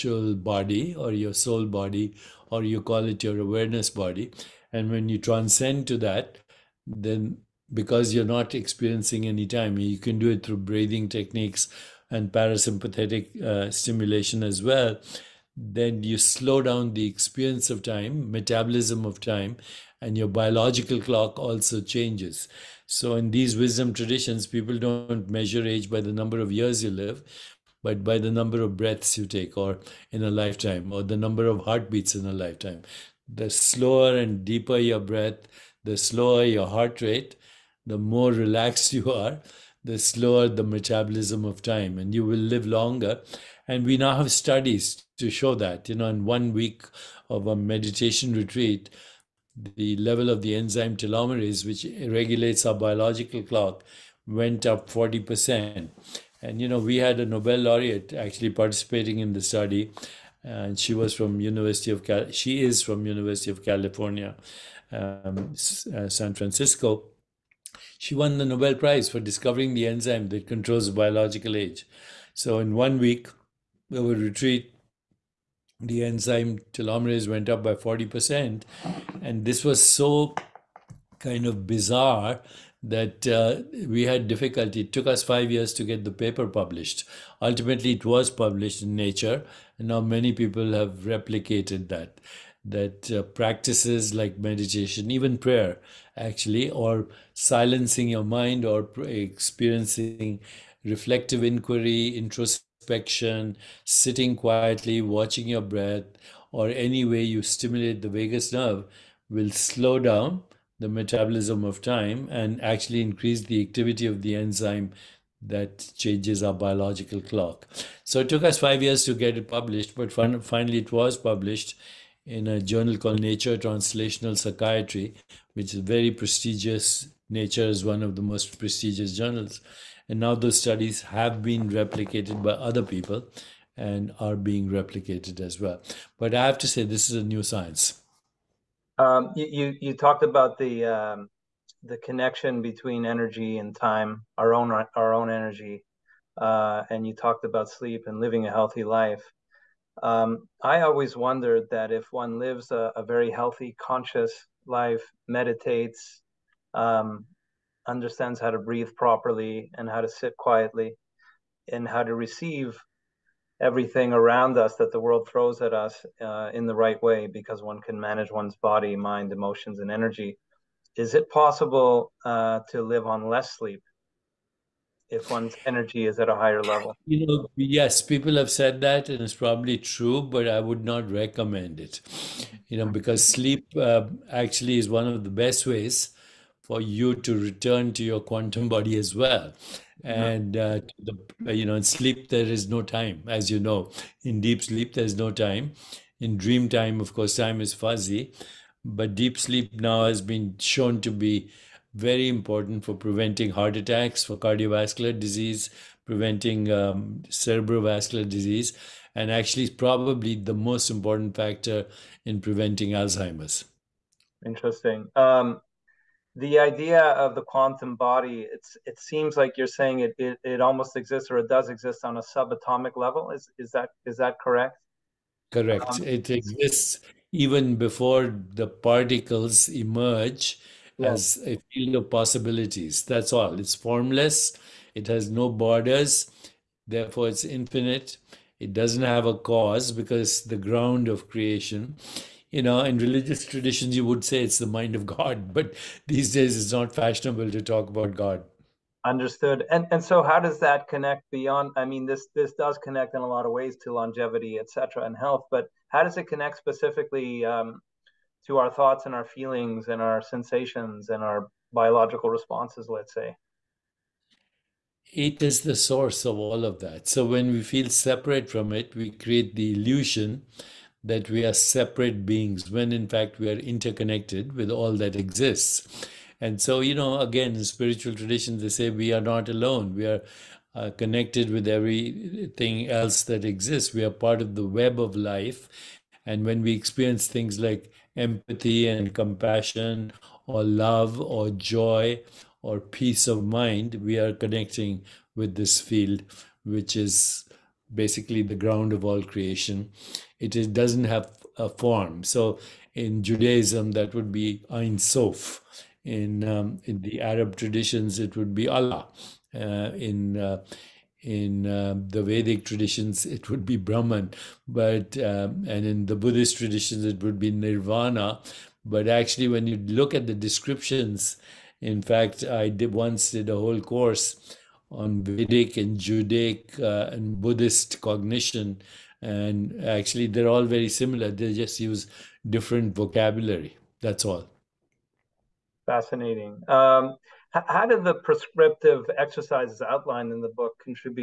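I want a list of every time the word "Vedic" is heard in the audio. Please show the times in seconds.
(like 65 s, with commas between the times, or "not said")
312 s, 325 s.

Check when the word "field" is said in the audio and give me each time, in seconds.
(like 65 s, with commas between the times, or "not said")
231 s, 295 s.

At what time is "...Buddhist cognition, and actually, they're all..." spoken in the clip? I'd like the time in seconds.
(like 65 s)
327 s.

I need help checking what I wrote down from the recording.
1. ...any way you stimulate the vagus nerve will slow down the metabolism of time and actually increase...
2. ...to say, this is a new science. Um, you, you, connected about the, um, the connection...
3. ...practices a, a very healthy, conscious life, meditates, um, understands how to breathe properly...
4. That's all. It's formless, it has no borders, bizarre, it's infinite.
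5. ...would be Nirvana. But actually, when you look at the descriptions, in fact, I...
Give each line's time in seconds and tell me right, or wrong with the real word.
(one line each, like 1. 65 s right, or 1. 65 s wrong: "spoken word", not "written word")
1. 106 s right
2. 136 s wrong: "talked", not "connected"
3. 152 s wrong: "lives", not "practices"
4. 233 s wrong: "therefore", not "bizarre"
5. 317 s right.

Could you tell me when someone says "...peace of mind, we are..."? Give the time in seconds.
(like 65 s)
292 s.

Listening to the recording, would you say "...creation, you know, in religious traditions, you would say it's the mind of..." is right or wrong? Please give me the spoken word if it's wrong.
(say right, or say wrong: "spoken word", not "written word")
right.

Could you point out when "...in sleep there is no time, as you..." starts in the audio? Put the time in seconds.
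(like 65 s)
191 s.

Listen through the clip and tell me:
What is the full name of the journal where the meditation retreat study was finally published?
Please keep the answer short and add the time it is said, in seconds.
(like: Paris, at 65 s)
Nature Translational Psychiatry, at 123 s.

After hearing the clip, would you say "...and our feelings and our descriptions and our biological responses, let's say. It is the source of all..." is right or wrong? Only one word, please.
wrong.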